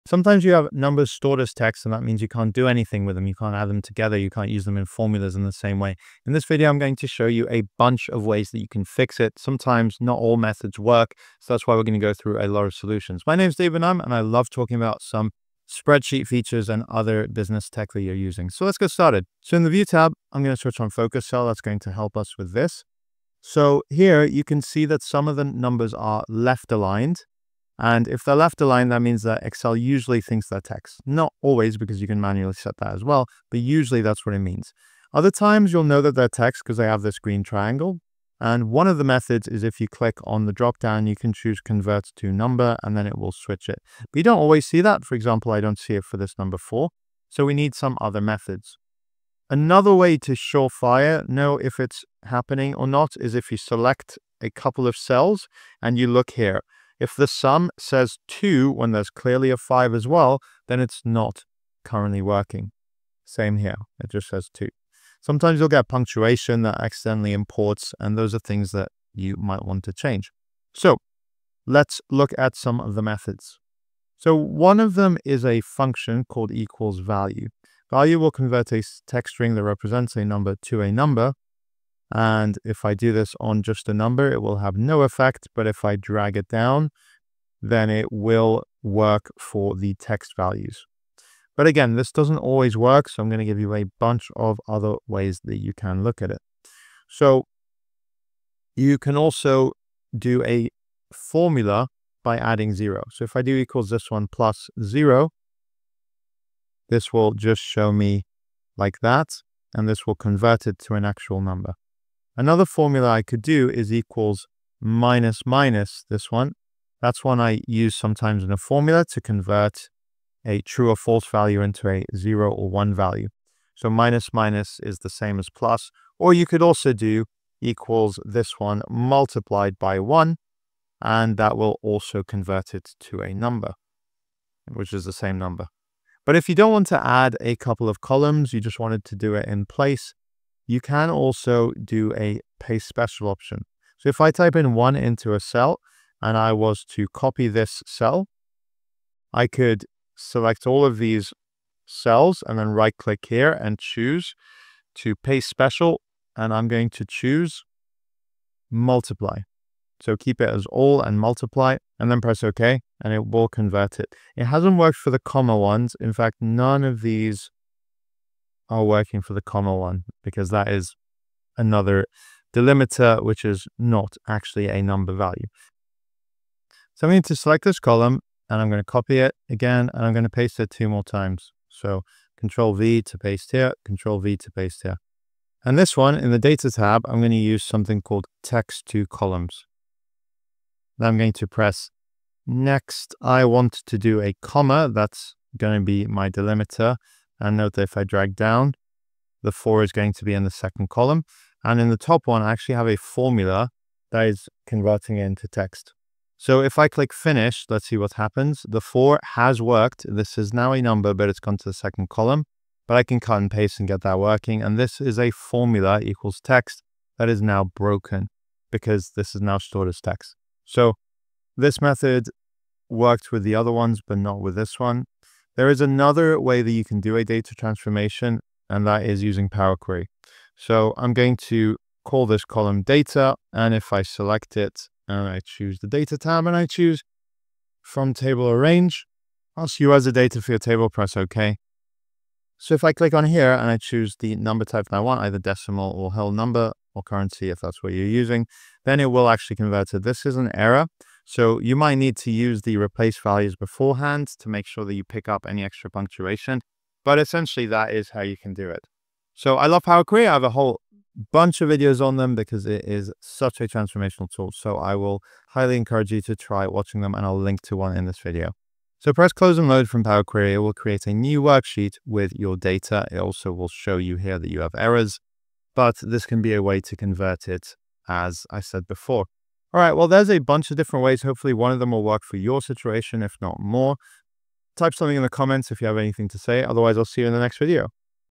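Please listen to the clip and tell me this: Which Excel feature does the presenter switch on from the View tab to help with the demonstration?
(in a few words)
Focus Cell.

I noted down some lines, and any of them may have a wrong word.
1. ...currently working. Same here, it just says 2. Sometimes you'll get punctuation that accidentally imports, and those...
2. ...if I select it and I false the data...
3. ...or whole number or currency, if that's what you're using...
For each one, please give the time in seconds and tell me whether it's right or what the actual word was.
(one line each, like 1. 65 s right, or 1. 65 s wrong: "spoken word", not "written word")
1. 61 s right
2. 233 s wrong: "choose", not "false"
3. 245 s right.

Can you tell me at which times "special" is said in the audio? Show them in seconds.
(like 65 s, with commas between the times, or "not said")
142 s, 155 s.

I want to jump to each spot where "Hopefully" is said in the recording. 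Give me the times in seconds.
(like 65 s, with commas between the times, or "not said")
281 s.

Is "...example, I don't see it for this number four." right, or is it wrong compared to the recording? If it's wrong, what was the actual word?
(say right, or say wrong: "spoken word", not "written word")
right.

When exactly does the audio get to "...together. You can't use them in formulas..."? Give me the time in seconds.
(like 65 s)
3 s.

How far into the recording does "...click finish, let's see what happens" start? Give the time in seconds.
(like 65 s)
206 s.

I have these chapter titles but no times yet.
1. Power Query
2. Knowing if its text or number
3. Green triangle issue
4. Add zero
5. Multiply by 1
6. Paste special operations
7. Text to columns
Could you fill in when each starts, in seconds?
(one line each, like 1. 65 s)
1. 225 s
2. 19 s
3. 34 s
4. 100 s
5. 126 s
6. 143 s
7. 184 s.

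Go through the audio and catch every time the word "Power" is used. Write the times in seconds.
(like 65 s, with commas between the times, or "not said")
229 s, 259 s, 270 s.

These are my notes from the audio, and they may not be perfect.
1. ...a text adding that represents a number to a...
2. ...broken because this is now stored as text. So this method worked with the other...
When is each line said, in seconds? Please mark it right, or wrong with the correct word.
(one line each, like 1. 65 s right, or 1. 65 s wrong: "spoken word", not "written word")
1. 78 s wrong: "string", not "adding"
2. 217 s right.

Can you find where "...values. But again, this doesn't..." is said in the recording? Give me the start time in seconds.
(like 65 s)
90 s.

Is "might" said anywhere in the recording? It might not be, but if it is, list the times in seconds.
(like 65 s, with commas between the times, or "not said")
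69 s, 251 s.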